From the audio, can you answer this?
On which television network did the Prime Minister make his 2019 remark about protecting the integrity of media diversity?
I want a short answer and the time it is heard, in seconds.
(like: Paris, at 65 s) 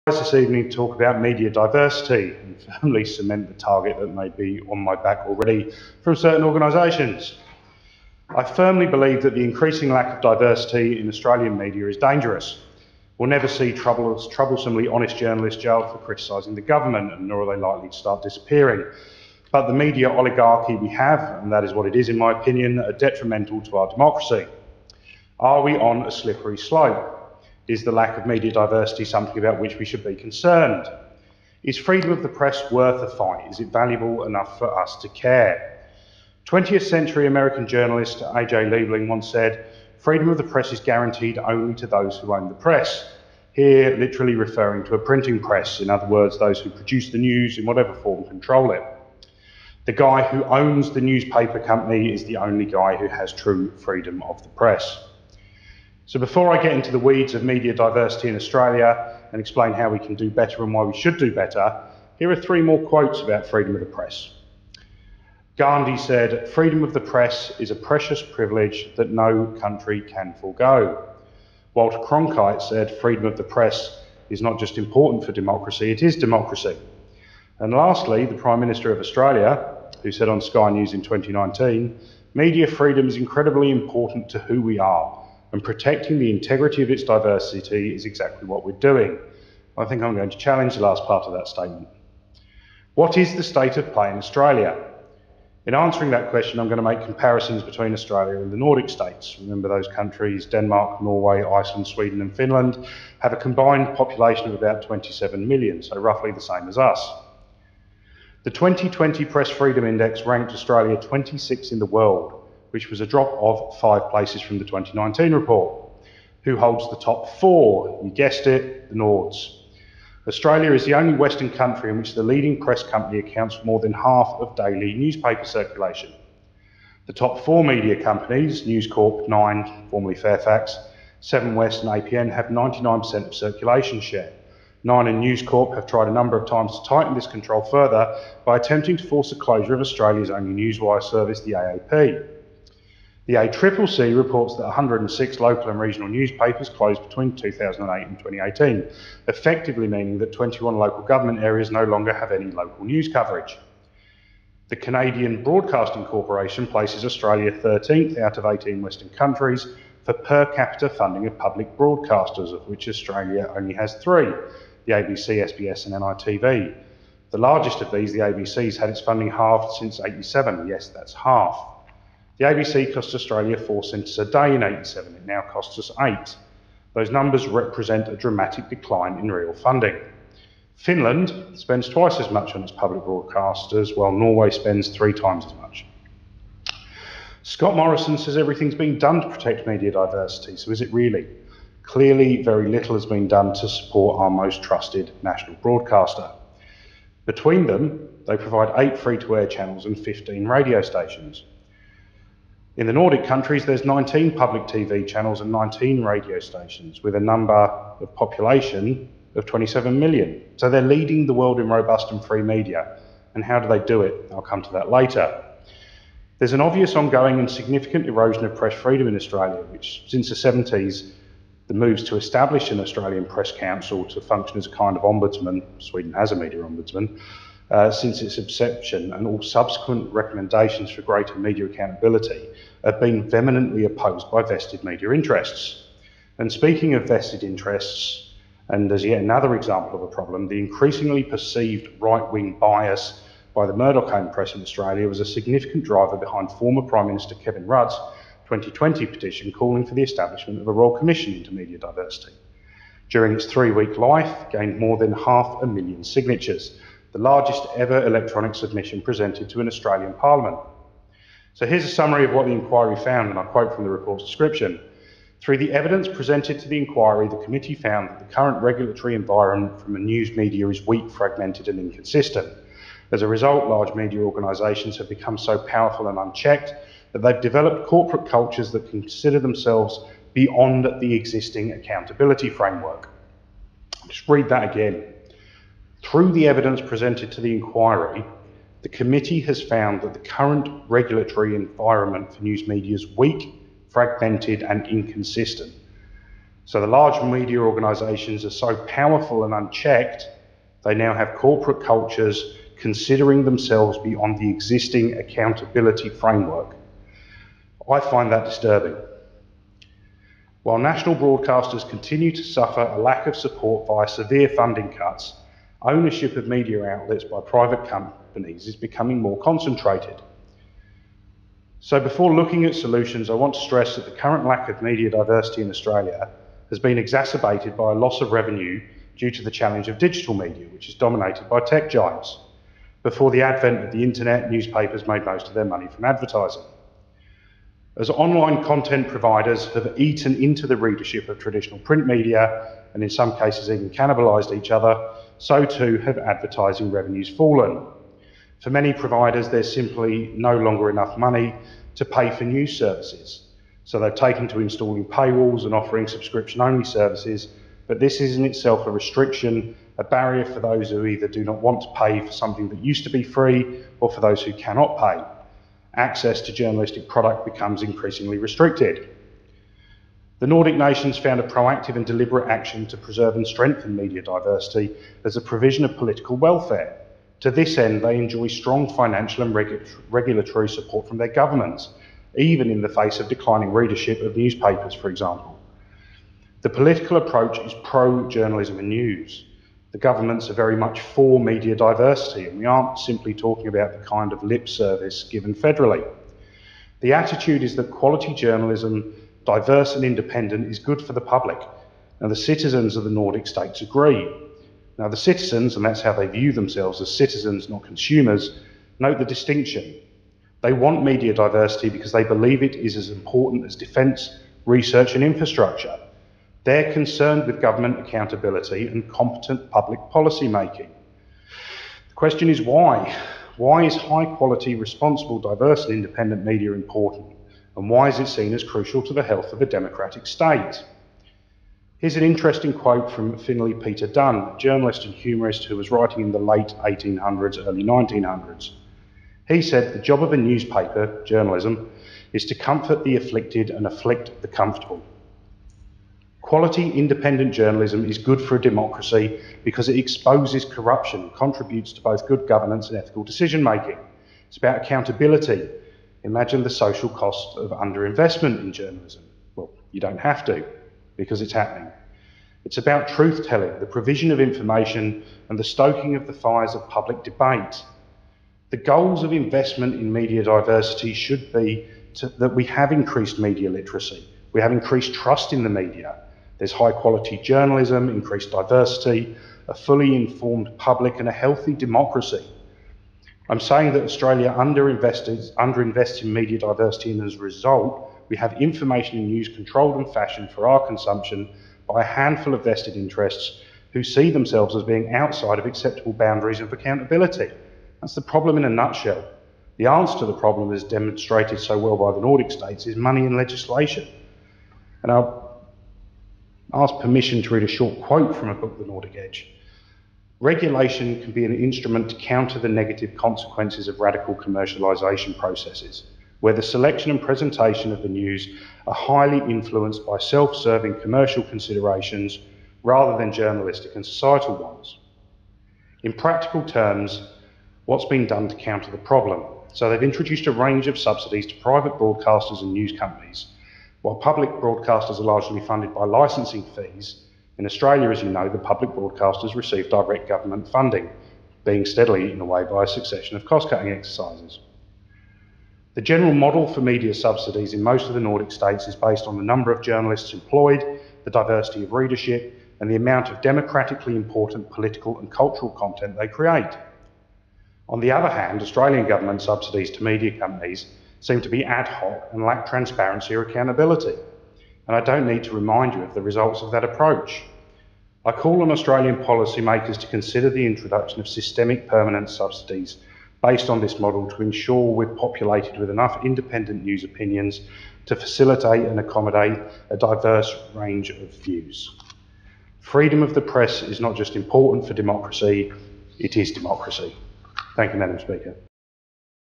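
Sky News, at 80 s.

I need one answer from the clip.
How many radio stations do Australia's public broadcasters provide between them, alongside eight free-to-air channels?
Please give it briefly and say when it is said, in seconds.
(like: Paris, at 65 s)
15, at 199 s.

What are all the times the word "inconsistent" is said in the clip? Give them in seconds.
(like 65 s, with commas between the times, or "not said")
271 s, 294 s.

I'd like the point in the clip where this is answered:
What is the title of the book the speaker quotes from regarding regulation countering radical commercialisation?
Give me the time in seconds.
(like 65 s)
508 s.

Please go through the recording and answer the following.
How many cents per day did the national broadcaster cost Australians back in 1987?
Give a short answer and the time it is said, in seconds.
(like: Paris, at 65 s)
4 cents, at 173 s.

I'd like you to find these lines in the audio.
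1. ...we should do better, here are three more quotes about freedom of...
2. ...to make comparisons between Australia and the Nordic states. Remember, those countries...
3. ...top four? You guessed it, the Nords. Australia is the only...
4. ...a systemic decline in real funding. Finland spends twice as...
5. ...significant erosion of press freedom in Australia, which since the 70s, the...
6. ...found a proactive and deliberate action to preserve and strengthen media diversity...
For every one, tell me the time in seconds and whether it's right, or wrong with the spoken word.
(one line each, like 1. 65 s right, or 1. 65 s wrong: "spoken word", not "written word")
1. 60 s right
2. 96 s right
3. 116 s right
4. 178 s wrong: "dramatic", not "systemic"
5. 217 s right
6. 371 s right.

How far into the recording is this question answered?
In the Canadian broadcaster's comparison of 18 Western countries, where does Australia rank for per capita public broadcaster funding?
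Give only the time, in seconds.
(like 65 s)
157 s.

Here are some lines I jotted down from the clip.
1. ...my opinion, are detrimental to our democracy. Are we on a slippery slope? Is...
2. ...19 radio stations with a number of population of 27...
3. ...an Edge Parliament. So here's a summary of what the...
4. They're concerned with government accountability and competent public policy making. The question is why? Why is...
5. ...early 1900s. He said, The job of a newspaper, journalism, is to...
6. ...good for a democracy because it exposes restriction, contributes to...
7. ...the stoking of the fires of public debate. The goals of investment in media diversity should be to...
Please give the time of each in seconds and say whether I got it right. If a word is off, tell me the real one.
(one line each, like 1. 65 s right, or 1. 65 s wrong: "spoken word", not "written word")
1. 22 s right
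2. 205 s right
3. 259 s wrong: "Australian", not "Edge"
4. 416 s right
5. 437 s right
6. 448 s wrong: "corruption", not "restriction"
7. 465 s right.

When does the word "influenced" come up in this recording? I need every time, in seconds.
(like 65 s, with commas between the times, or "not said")
519 s.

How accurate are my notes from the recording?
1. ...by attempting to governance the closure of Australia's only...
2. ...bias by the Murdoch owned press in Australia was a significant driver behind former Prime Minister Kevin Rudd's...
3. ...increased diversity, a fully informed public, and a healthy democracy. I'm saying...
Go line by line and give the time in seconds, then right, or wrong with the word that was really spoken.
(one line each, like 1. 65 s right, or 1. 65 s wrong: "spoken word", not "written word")
1. 138 s wrong: "force", not "governance"
2. 242 s right
3. 478 s right.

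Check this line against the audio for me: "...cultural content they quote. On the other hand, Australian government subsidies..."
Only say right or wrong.
wrong.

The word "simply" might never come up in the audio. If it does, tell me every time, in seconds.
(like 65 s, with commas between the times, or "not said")
349 s, 392 s.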